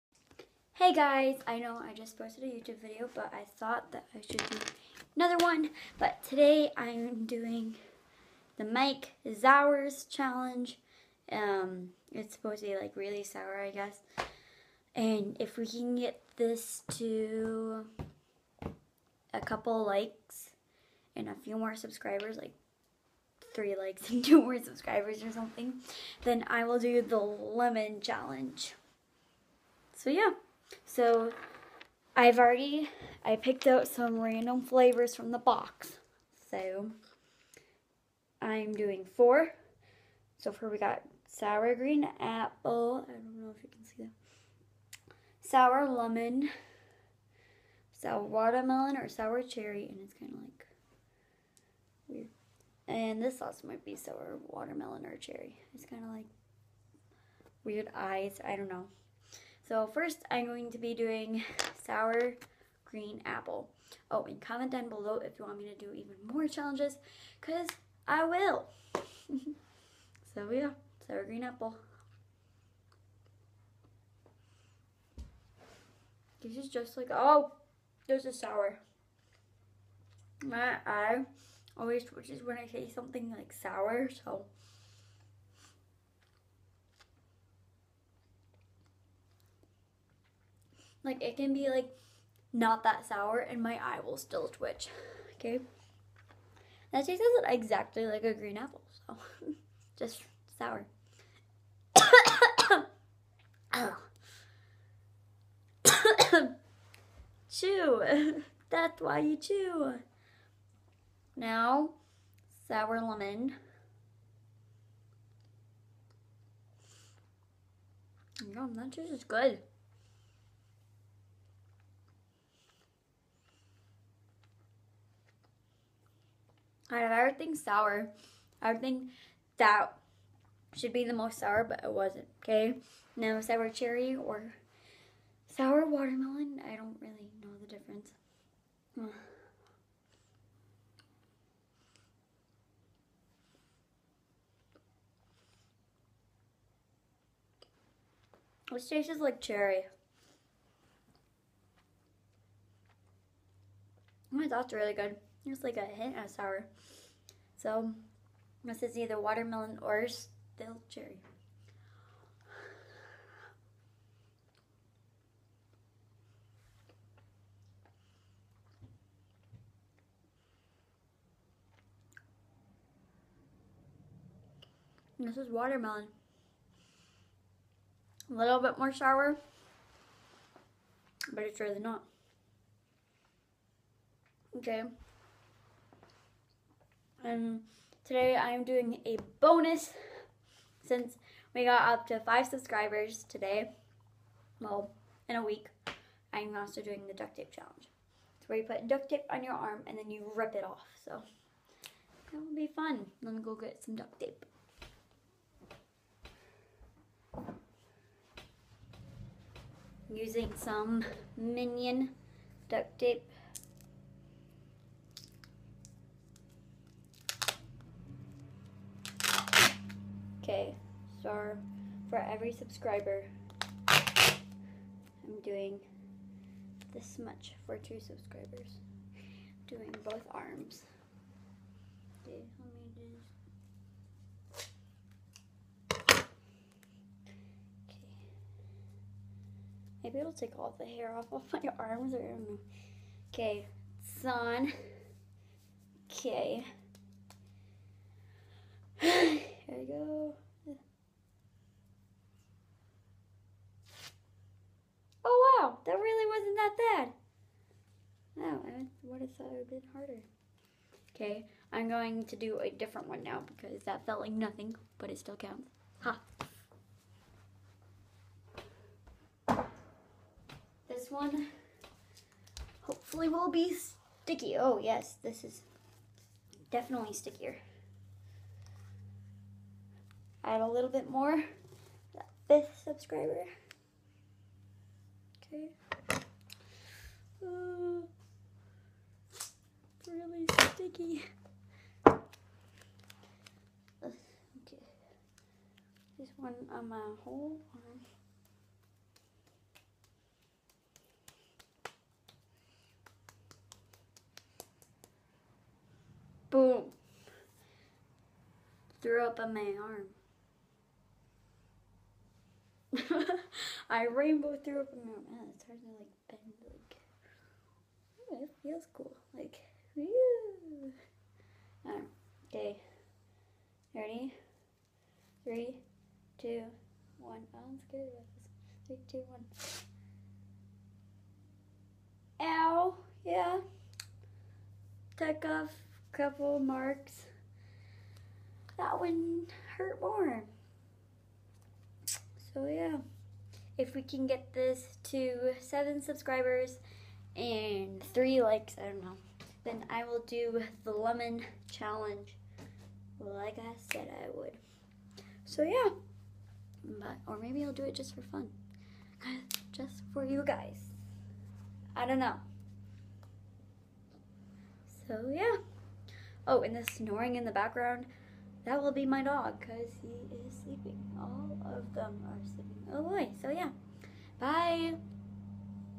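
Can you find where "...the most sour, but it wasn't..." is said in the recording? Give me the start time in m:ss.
2:11.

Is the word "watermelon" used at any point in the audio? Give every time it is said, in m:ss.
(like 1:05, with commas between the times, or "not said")
0:48, 0:54, 2:15, 2:39, 2:55.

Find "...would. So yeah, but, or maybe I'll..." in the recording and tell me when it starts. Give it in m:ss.
5:54.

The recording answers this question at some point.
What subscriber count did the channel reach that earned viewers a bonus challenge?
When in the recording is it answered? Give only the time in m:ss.
3:12.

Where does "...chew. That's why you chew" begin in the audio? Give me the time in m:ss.
1:47.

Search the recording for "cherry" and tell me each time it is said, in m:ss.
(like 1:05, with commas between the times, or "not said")
0:49, 0:55, 2:13, 2:29, 2:40.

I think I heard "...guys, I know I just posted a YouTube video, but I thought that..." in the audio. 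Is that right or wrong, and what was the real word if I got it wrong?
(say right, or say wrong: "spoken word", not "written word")
right.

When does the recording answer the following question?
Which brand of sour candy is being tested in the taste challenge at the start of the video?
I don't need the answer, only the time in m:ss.
0:08.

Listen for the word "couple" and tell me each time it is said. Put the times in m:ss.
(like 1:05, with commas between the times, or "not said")
0:19, 5:36.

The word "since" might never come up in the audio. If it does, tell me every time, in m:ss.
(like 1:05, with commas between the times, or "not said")
3:10.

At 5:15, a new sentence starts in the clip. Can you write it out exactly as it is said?
Oh, it's hard to like bend like it feels cool.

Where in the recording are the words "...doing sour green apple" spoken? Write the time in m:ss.
1:00.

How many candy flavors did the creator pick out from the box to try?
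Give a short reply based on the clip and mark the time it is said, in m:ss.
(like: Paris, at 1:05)
4, at 0:39.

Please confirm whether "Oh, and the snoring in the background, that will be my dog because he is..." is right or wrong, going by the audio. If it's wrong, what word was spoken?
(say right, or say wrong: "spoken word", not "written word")
right.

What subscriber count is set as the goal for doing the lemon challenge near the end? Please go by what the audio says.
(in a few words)
7.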